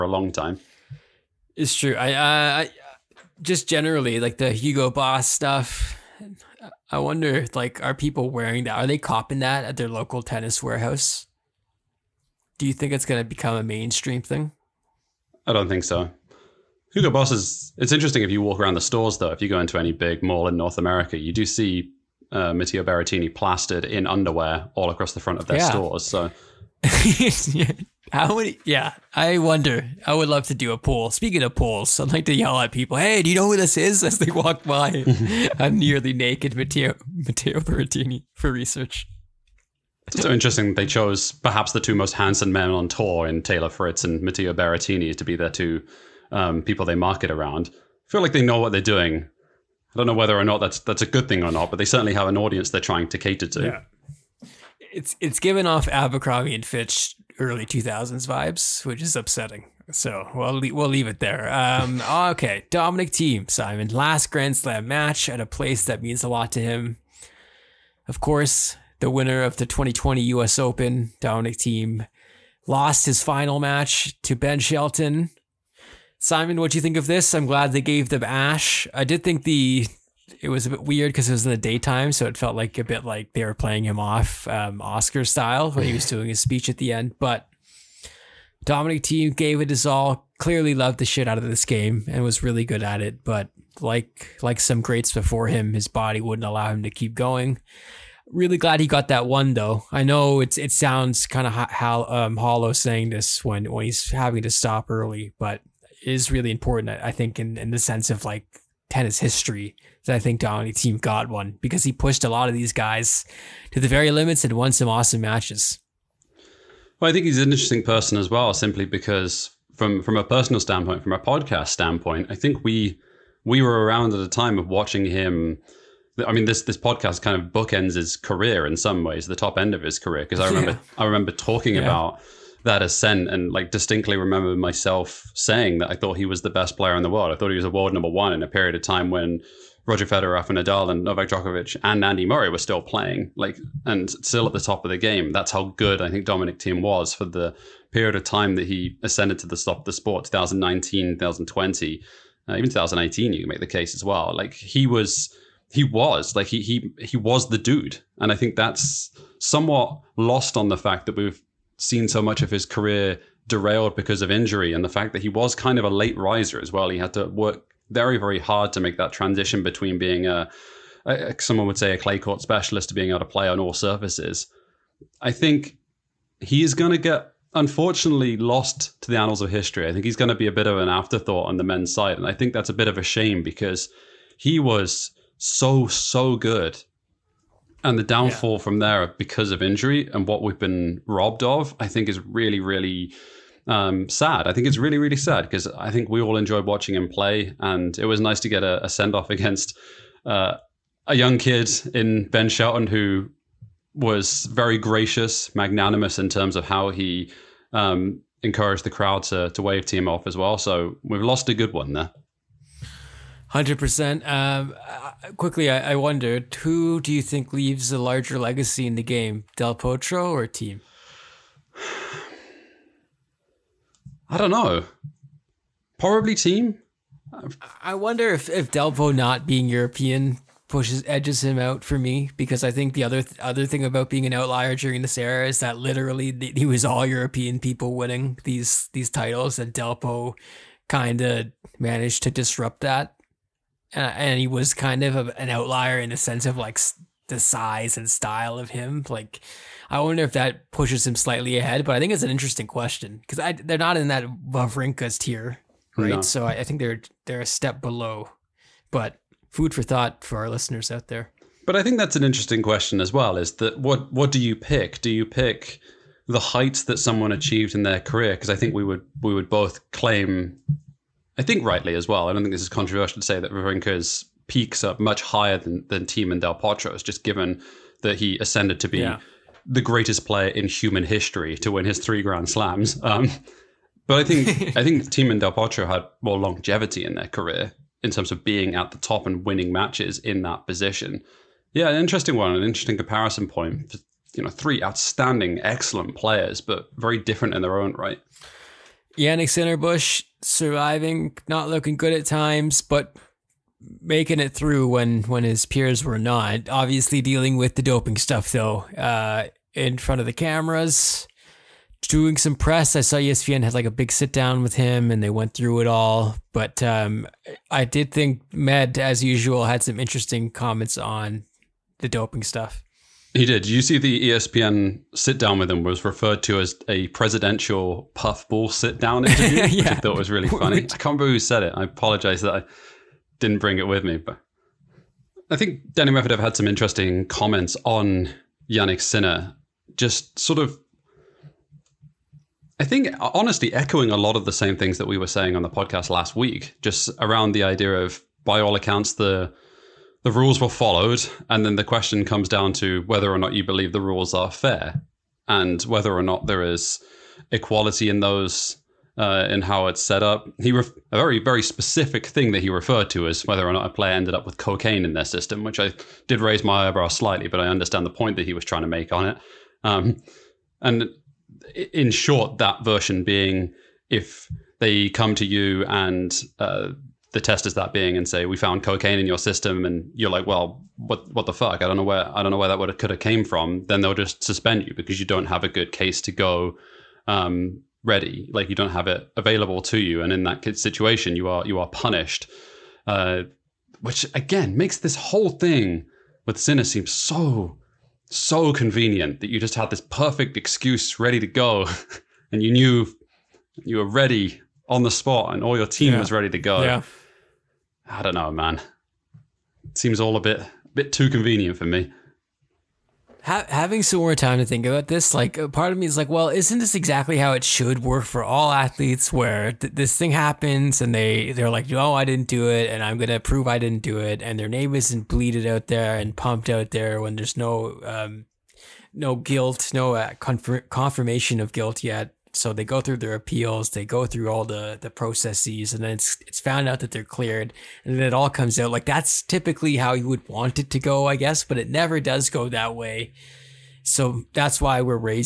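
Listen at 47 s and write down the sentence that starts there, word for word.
I feel like they know what they're doing.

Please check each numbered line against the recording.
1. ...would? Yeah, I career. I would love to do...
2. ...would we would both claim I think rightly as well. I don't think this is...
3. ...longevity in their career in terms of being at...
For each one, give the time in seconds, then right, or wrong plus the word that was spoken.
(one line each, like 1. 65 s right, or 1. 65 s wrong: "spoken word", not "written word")
1. 28 s wrong: "wonder", not "career"
2. 268 s right
3. 286 s right.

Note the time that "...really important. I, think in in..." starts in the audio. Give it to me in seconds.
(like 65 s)
106 s.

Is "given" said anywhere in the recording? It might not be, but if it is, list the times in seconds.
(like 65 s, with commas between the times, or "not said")
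55 s, 277 s.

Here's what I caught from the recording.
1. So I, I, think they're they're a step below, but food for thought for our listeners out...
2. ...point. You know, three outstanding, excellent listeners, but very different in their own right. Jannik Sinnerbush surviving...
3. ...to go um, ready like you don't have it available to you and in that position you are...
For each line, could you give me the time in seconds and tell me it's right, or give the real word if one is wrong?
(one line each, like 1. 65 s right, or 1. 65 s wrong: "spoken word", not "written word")
1. 256 s right
2. 293 s wrong: "players", not "listeners"
3. 386 s wrong: "situation", not "position".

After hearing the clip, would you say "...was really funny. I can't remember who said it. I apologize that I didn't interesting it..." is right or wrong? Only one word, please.
wrong.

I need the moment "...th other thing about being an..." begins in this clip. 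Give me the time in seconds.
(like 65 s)
233 s.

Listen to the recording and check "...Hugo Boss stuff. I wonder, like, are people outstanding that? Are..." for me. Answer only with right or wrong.
wrong.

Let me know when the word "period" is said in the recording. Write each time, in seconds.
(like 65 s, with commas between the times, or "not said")
138 s, 147 s.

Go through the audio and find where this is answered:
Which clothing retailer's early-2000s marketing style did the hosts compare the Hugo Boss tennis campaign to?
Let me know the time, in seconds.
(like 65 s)
55 s.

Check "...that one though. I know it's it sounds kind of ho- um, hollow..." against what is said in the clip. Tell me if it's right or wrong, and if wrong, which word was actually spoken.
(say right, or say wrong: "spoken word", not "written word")
right.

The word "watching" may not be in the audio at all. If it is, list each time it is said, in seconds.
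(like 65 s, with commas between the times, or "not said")
124 s, 196 s.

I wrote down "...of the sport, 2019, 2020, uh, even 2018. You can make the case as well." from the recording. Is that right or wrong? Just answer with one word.
right.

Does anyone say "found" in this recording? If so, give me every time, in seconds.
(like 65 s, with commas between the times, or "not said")
378 s, 436 s.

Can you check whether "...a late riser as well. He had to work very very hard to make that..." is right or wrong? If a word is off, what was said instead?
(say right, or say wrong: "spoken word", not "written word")
right.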